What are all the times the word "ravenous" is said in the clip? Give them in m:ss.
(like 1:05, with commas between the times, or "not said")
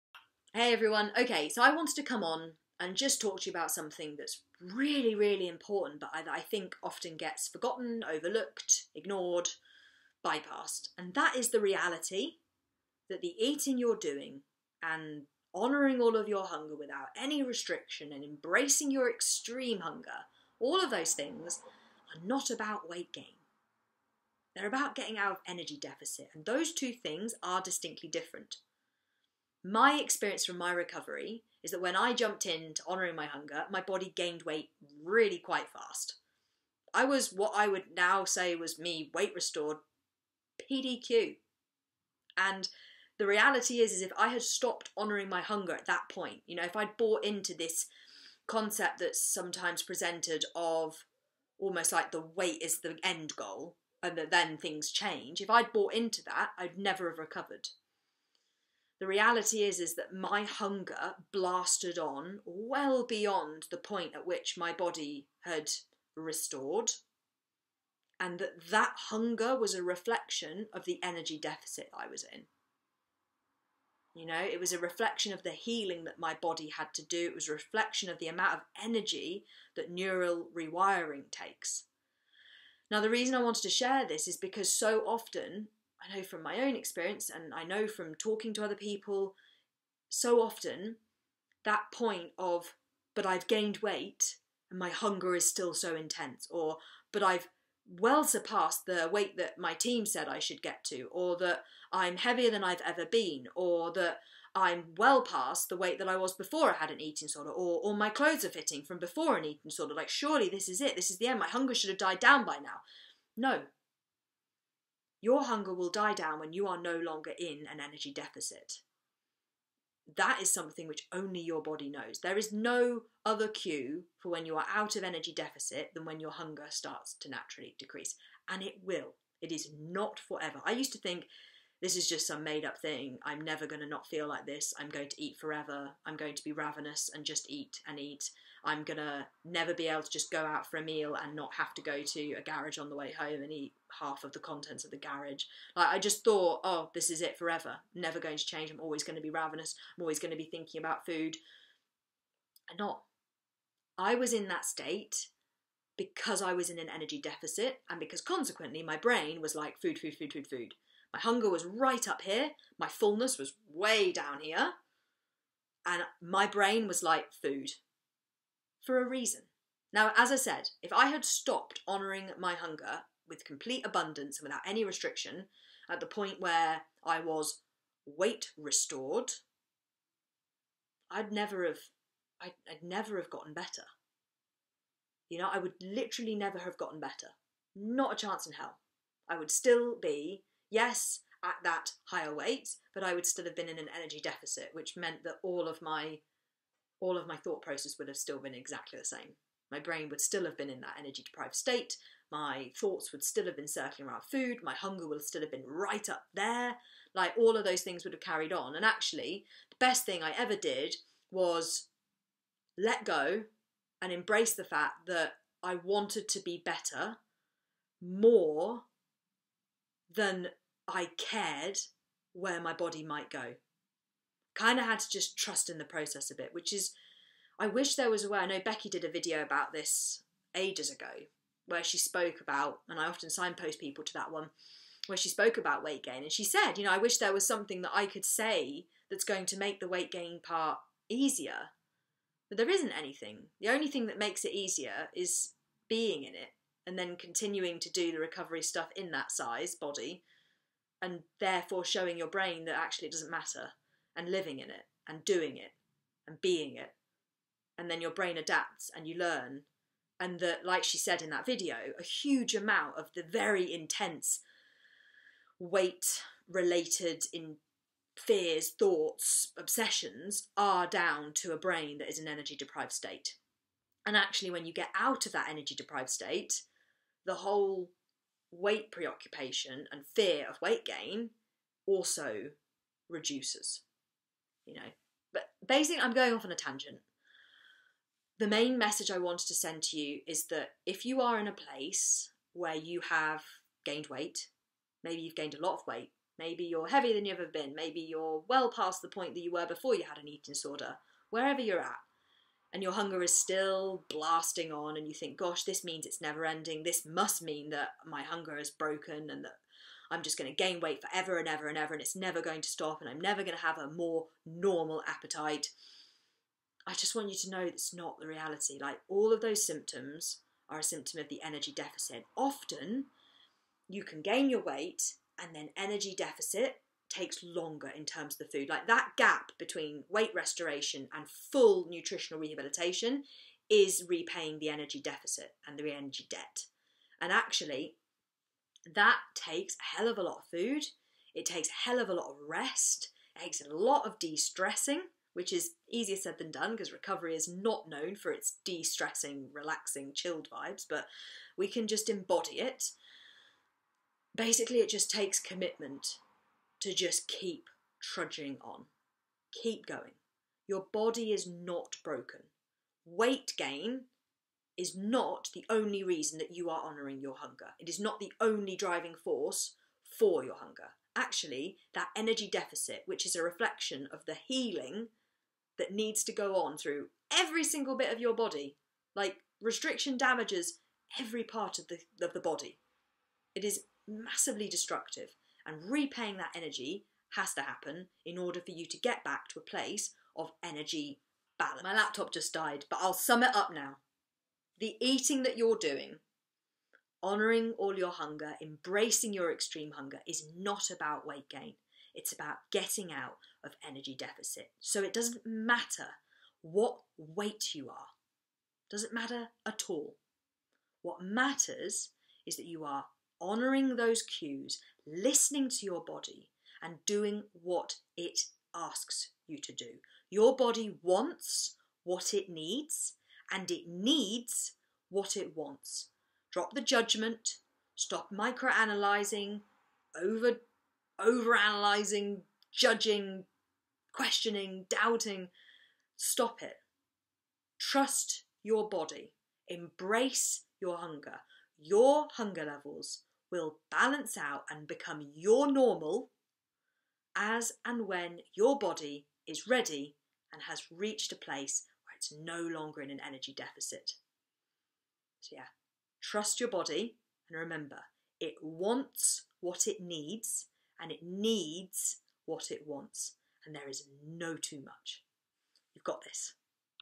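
2:16, 2:29.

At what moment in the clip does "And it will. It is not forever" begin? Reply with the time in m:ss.
2:08.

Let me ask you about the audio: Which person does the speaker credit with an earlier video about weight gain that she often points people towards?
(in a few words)
Becky.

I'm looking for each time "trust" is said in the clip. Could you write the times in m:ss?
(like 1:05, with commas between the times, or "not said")
3:45, 7:17, 7:36.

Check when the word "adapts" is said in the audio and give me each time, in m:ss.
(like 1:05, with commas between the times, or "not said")
4:18.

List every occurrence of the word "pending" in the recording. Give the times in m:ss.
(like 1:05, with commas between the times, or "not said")
not said.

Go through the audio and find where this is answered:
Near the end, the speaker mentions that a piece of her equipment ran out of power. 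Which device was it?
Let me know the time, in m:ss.
6:31.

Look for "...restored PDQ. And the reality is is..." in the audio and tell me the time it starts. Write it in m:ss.
0:39.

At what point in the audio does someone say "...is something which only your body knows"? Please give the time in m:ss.
2:00.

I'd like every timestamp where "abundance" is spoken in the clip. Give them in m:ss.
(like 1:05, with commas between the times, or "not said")
2:53.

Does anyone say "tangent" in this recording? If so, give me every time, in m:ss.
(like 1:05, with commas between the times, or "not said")
4:46.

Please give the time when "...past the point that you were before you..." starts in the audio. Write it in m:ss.
4:58.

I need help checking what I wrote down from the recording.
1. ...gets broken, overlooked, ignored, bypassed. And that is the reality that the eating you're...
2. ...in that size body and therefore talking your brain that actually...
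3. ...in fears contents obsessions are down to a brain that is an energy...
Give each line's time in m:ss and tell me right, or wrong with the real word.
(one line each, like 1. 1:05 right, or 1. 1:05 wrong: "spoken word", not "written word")
1. 0:07 wrong: "forgotten", not "broken"
2. 4:08 wrong: "showing", not "talking"
3. 4:27 wrong: "thoughts", not "contents".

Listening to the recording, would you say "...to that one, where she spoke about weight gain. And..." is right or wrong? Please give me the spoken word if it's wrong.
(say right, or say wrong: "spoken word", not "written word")
right.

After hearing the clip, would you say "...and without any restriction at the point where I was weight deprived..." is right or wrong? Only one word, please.
wrong.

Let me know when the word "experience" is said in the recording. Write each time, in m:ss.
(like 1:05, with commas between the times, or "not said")
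0:30, 1:26.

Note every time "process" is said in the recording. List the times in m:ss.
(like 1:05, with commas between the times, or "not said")
3:17, 3:45.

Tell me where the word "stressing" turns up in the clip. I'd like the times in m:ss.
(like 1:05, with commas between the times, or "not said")
5:44, 5:48.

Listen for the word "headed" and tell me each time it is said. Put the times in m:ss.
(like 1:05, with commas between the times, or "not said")
not said.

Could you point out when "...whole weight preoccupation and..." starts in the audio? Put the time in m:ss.
4:37.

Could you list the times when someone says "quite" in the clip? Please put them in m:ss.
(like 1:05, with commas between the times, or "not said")
0:35.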